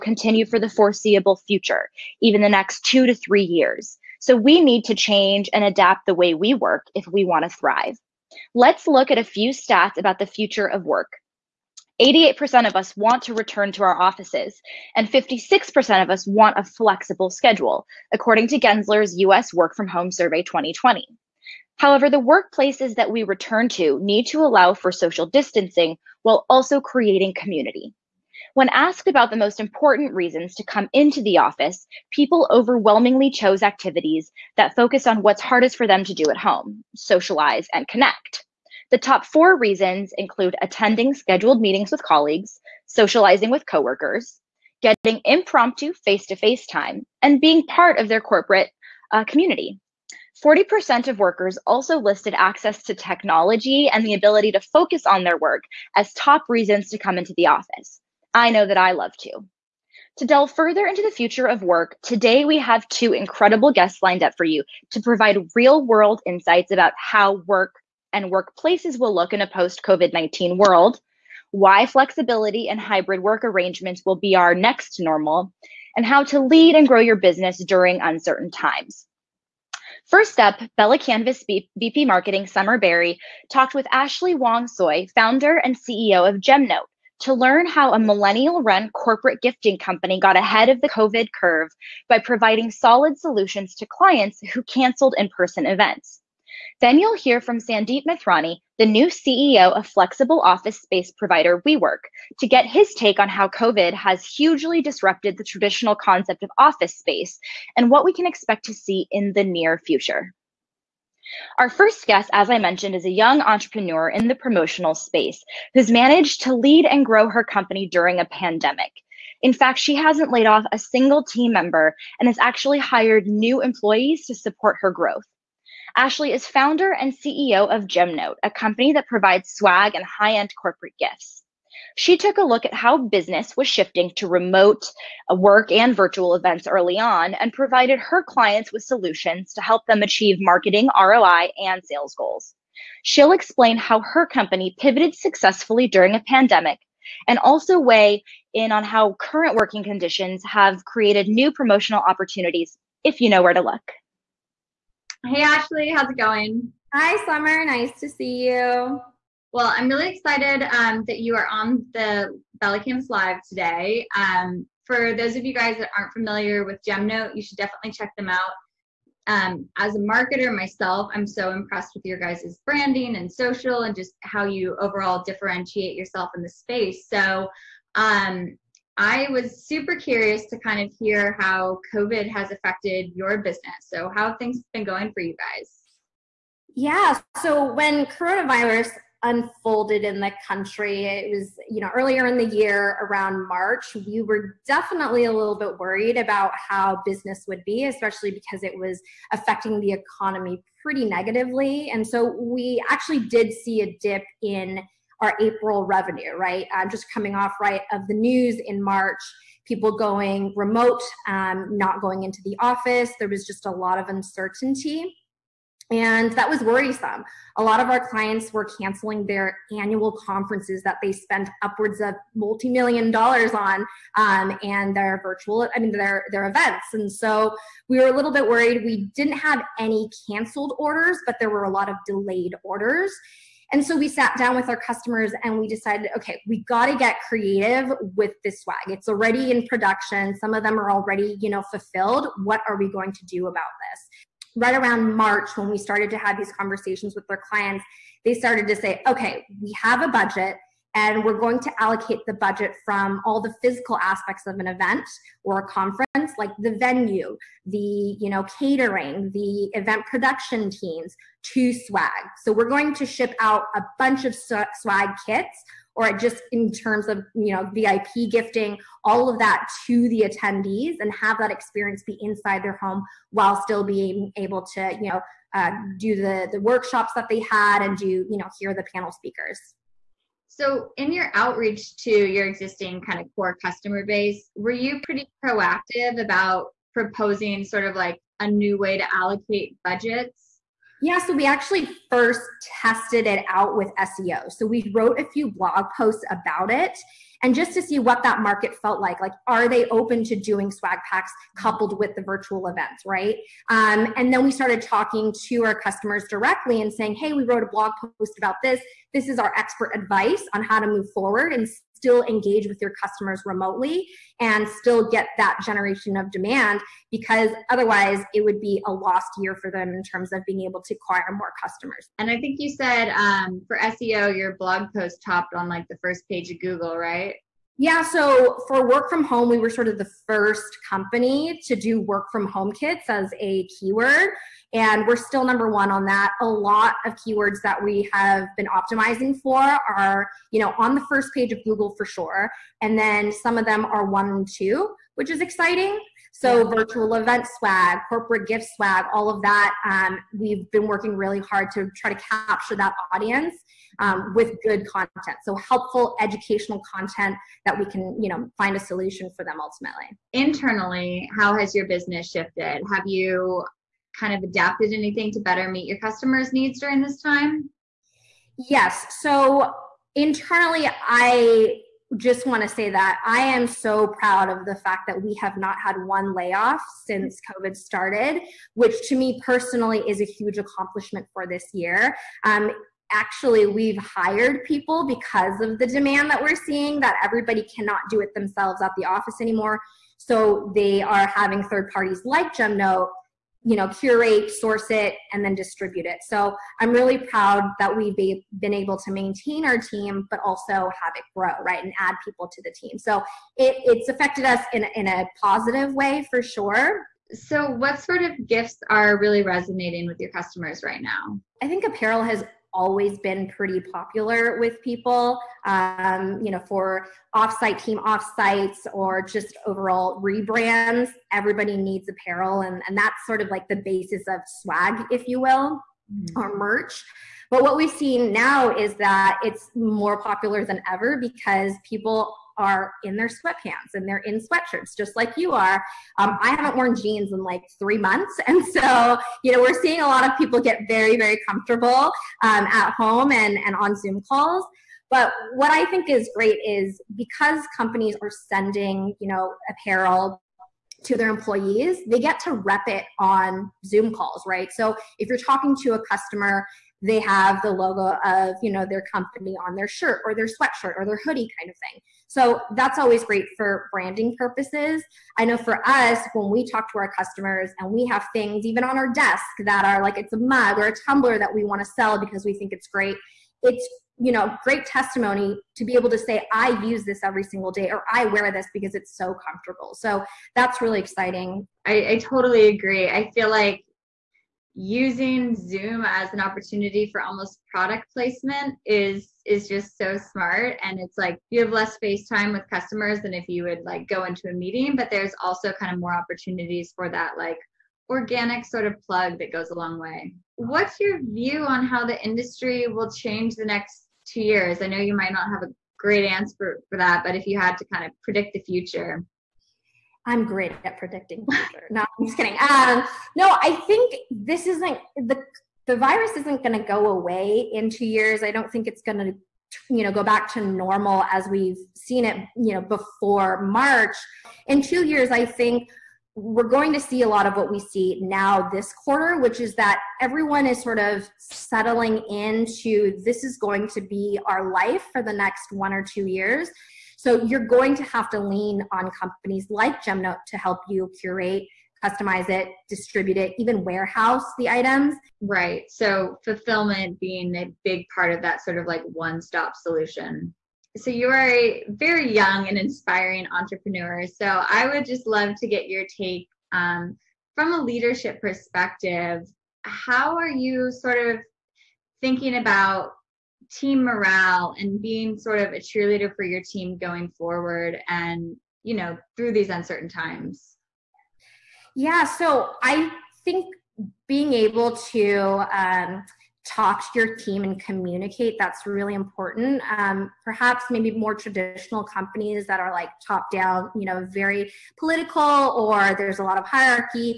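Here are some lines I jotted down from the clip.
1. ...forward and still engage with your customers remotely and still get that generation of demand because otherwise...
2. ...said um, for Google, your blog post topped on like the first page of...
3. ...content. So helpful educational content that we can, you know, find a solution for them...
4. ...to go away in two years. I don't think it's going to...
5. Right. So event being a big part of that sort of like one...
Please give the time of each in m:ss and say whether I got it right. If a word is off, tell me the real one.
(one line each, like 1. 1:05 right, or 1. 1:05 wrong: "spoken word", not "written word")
1. 5:11 right
2. 5:22 wrong: "SEO", not "Google"
3. 5:54 right
4. 8:36 right
5. 9:05 wrong: "fulfillment", not "event".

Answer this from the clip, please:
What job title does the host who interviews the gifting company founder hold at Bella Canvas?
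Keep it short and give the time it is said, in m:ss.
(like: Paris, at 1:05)
VP Marketing, at 1:21.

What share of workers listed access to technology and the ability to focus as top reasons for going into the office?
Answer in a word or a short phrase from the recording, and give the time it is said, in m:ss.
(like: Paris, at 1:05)
40%, at 0:50.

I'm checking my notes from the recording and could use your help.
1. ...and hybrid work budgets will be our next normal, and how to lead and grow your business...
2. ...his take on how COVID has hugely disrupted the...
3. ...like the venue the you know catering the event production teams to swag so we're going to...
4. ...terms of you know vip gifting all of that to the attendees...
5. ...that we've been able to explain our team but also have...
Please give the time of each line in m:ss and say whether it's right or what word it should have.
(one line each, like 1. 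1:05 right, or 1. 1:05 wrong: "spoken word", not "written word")
1. 1:12 wrong: "arrangements", not "budgets"
2. 1:42 right
3. 4:16 right
4. 4:26 right
5. 6:37 wrong: "maintain", not "explain".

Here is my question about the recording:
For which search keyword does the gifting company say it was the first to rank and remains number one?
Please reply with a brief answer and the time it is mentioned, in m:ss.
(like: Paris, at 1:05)
work from home kits, at 5:31.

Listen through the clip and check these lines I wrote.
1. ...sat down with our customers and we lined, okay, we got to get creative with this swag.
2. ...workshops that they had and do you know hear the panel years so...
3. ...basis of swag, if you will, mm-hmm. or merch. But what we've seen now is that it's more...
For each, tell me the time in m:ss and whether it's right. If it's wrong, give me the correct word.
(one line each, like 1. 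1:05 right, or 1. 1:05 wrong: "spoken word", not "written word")
1. 3:54 wrong: "decided", not "lined"
2. 4:36 wrong: "speakers", not "years"
3. 7:03 right.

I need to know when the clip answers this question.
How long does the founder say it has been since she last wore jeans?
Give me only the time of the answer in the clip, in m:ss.
7:17.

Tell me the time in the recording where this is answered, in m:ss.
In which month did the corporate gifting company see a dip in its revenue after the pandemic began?
3:25.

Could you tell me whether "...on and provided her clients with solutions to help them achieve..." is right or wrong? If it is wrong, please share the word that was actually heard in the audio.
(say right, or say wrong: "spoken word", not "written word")
right.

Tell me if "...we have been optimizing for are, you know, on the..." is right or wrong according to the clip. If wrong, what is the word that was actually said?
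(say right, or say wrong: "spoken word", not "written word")
right.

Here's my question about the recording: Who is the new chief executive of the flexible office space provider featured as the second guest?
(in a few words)
Sandeep Mathrani.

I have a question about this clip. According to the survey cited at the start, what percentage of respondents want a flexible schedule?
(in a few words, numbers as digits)
56%.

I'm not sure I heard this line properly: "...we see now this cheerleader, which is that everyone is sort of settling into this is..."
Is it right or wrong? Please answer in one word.
wrong.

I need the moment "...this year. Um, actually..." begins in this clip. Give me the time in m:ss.
6:21.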